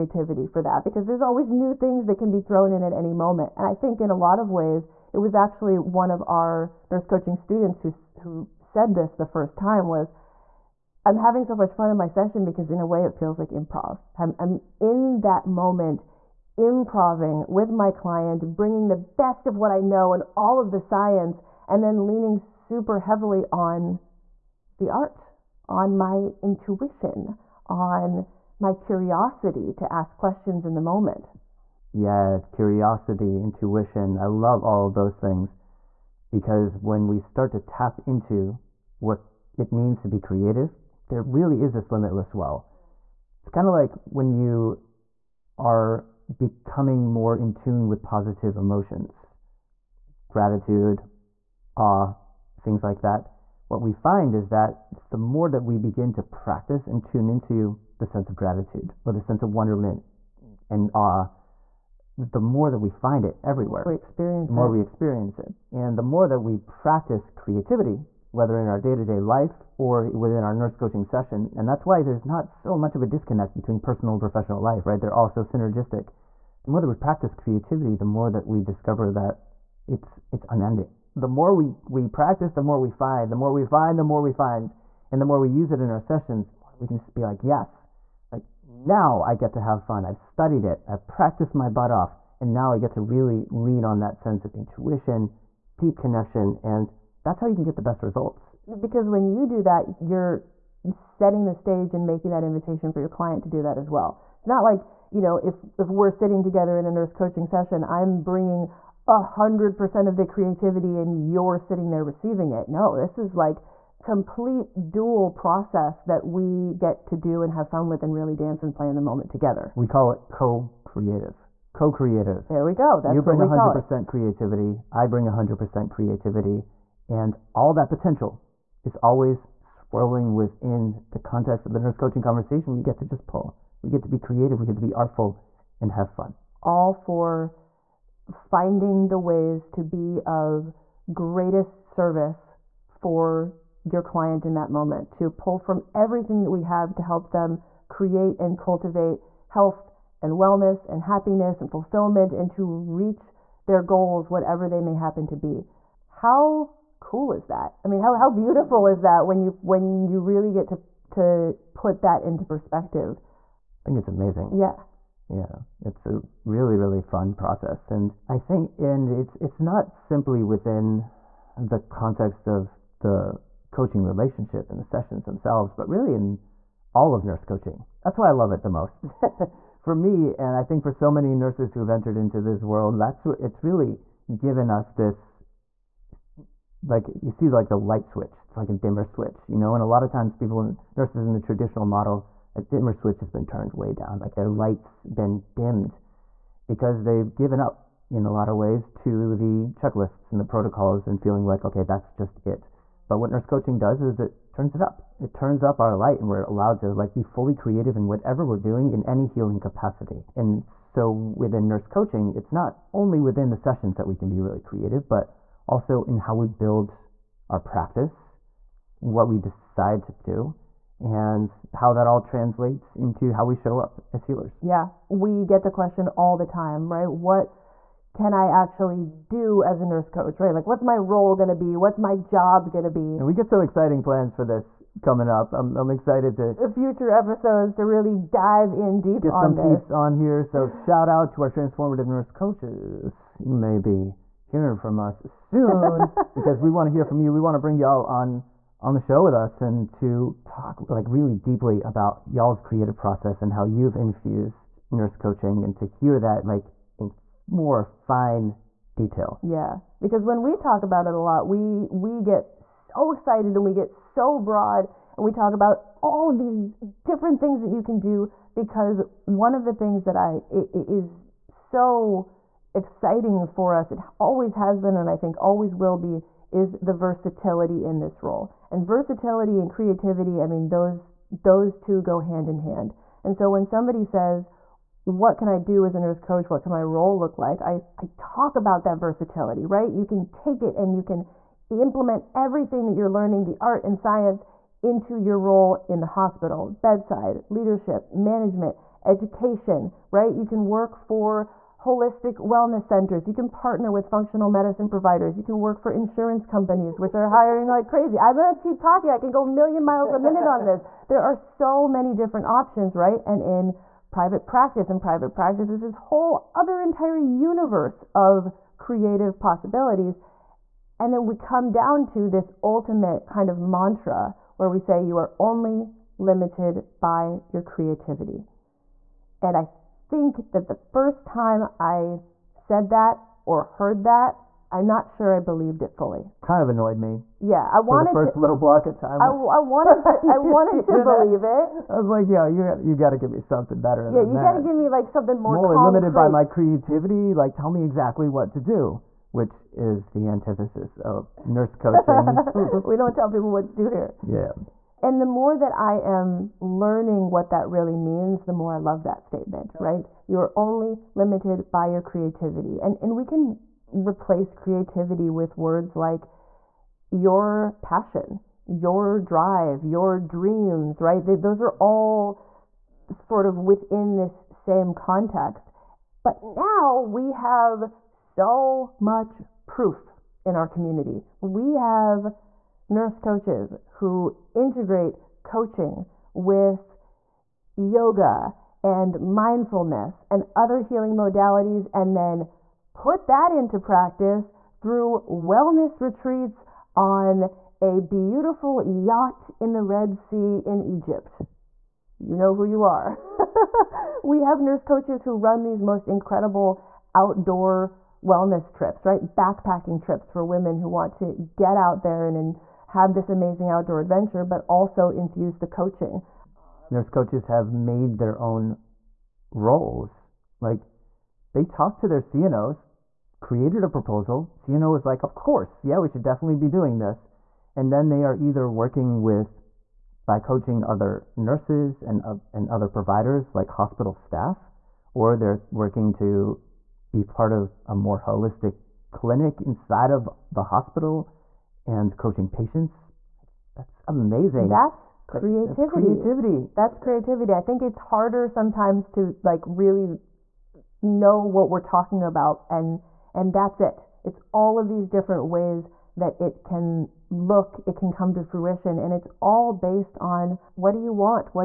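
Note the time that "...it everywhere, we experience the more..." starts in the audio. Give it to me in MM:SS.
01:03.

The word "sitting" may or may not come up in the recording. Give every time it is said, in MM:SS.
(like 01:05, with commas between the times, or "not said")
01:46, 01:51.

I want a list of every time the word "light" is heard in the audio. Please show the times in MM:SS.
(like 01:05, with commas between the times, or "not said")
03:07, 03:14, 03:25.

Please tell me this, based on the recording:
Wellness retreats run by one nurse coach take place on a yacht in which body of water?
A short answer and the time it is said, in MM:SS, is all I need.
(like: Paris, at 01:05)
Red Sea, at 06:39.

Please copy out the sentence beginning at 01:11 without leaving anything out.
And that's why there's not so much of a disconnect between personal and professional life, right?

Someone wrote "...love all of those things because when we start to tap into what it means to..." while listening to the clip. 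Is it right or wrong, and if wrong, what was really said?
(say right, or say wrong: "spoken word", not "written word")
right.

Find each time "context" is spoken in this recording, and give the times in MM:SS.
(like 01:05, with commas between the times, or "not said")
02:11, 02:51, 06:14.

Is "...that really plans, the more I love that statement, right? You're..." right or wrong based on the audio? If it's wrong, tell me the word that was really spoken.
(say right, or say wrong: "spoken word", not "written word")
wrong: "means", not "plans".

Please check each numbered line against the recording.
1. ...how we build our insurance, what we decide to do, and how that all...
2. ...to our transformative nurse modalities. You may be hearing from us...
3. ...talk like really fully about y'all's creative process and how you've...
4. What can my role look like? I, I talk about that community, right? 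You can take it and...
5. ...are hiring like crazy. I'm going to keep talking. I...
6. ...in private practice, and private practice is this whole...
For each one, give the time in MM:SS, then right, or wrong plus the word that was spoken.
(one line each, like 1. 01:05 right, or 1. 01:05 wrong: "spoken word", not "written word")
1. 03:36 wrong: "practice", not "insurance"
2. 04:01 wrong: "coaches", not "modalities"
3. 04:10 wrong: "deeply", not "fully"
4. 04:46 wrong: "versatility", not "community"
5. 05:07 right
6. 05:13 right.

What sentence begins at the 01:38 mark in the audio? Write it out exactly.
Because when you do that, you're setting the stage and making that invitation for your client to do that as well.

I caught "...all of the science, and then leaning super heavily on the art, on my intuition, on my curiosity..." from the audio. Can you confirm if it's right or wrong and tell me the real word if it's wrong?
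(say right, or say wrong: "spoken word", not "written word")
right.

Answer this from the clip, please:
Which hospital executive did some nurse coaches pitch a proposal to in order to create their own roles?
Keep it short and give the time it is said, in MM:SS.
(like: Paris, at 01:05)
CNO, at 07:02.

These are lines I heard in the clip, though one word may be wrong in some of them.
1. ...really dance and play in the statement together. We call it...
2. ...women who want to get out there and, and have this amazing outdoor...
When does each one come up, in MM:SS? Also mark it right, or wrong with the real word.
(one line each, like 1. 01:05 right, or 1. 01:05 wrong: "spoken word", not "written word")
1. 01:58 wrong: "moment", not "statement"
2. 06:50 right.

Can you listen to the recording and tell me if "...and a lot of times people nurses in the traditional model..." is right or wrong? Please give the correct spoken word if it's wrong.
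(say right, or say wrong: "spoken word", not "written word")
right.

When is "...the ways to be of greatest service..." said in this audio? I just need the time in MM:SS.
02:19.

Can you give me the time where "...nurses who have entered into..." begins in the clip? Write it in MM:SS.
03:01.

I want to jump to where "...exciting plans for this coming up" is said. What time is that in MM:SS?
03:53.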